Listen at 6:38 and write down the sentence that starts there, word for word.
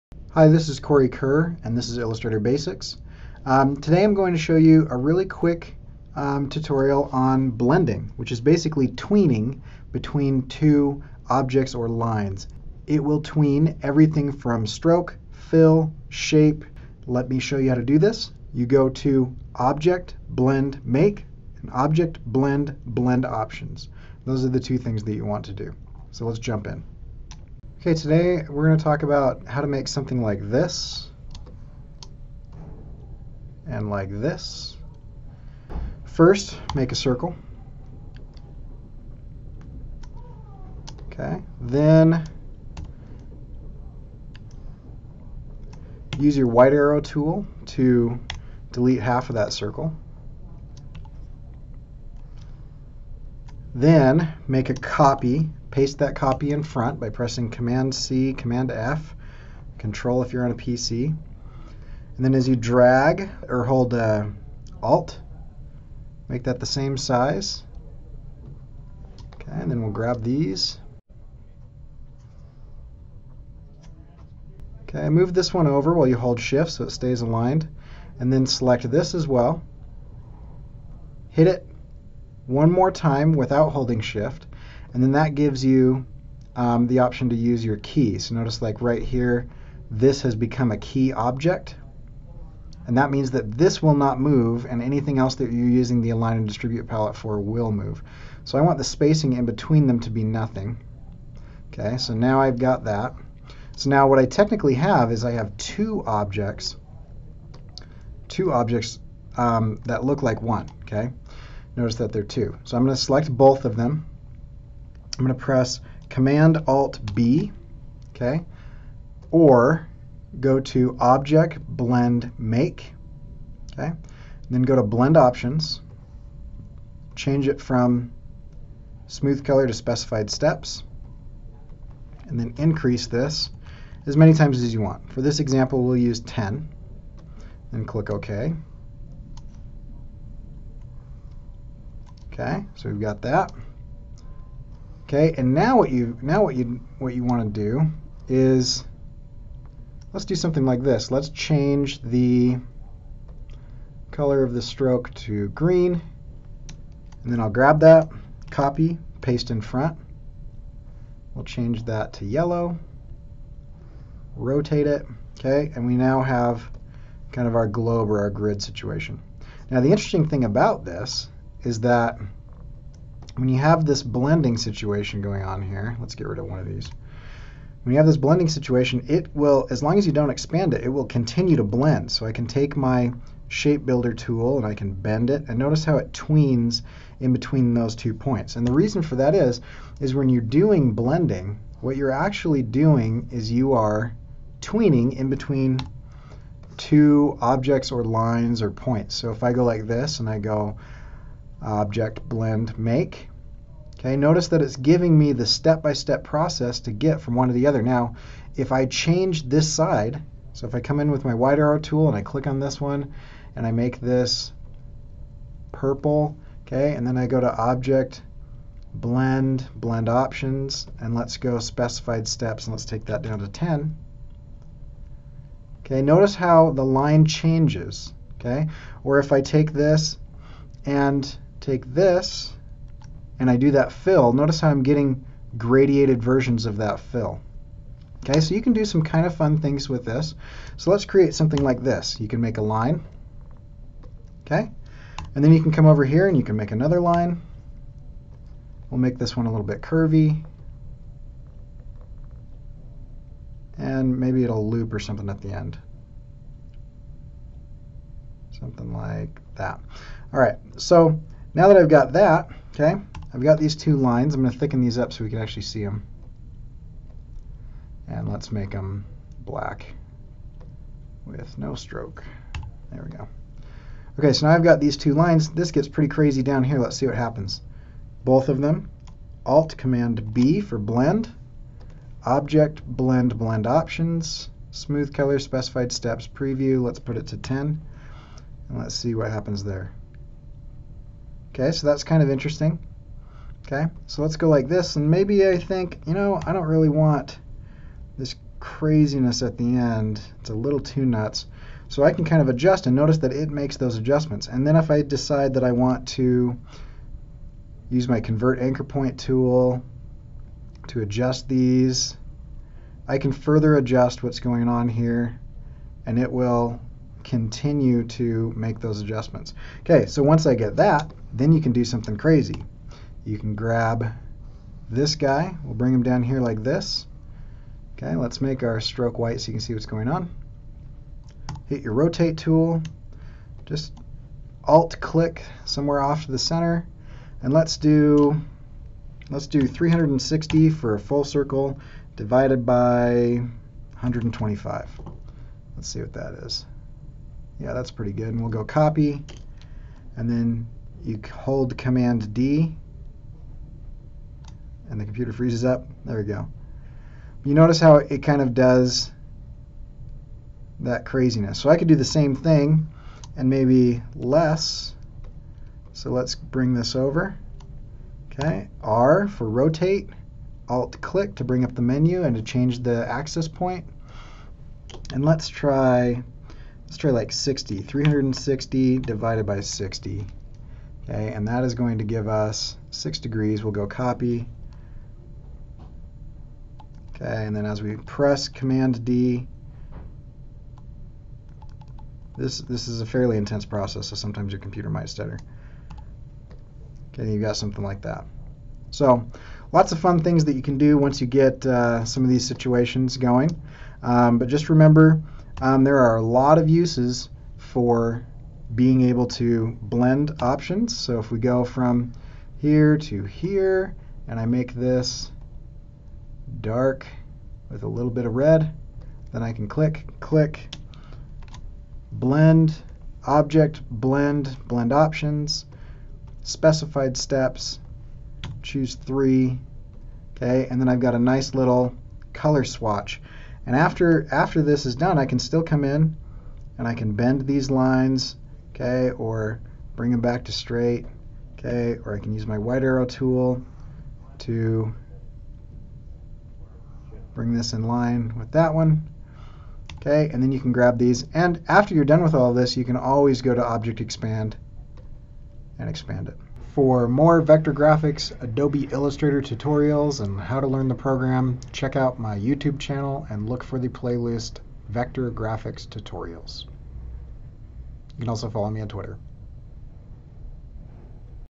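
So lots of fun things that you can do once you get uh, some of these situations going.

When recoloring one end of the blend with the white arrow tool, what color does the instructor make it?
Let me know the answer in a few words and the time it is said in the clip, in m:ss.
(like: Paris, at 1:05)
purple, at 3:35.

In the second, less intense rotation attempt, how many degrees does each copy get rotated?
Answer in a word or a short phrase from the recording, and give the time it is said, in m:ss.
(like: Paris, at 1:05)
6 degrees, at 6:22.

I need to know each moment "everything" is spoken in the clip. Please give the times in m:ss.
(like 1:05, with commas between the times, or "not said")
0:13.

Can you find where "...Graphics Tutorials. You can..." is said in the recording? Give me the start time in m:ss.
7:45.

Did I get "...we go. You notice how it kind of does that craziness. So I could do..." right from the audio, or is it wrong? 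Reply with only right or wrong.
right.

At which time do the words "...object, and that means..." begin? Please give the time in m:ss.
1:31.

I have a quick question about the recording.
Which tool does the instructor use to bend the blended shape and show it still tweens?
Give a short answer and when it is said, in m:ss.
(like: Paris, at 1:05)
shape builder tool, at 3:03.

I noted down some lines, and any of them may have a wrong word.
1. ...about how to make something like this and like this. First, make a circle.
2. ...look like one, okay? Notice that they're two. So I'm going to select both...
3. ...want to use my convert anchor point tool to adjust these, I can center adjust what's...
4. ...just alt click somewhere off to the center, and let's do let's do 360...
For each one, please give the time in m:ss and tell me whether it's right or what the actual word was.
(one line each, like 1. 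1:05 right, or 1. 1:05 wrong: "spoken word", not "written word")
1. 0:29 right
2. 1:50 right
3. 5:05 wrong: "further", not "center"
4. 5:33 right.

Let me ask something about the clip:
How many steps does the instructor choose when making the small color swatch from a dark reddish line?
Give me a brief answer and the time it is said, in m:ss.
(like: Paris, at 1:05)
3, at 7:08.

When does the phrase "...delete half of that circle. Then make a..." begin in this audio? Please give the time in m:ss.
0:48.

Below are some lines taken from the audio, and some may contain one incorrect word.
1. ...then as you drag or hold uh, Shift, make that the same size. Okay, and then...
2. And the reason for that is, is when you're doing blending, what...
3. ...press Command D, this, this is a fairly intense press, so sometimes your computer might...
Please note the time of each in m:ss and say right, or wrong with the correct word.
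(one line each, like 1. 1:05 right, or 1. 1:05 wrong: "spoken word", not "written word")
1. 1:02 wrong: "Alt", not "Shift"
2. 3:08 right
3. 6:27 wrong: "process", not "press".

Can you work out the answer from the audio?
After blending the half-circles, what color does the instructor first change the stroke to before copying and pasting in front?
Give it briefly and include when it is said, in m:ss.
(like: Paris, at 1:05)
green, at 2:35.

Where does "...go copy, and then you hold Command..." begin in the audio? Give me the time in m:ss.
5:48.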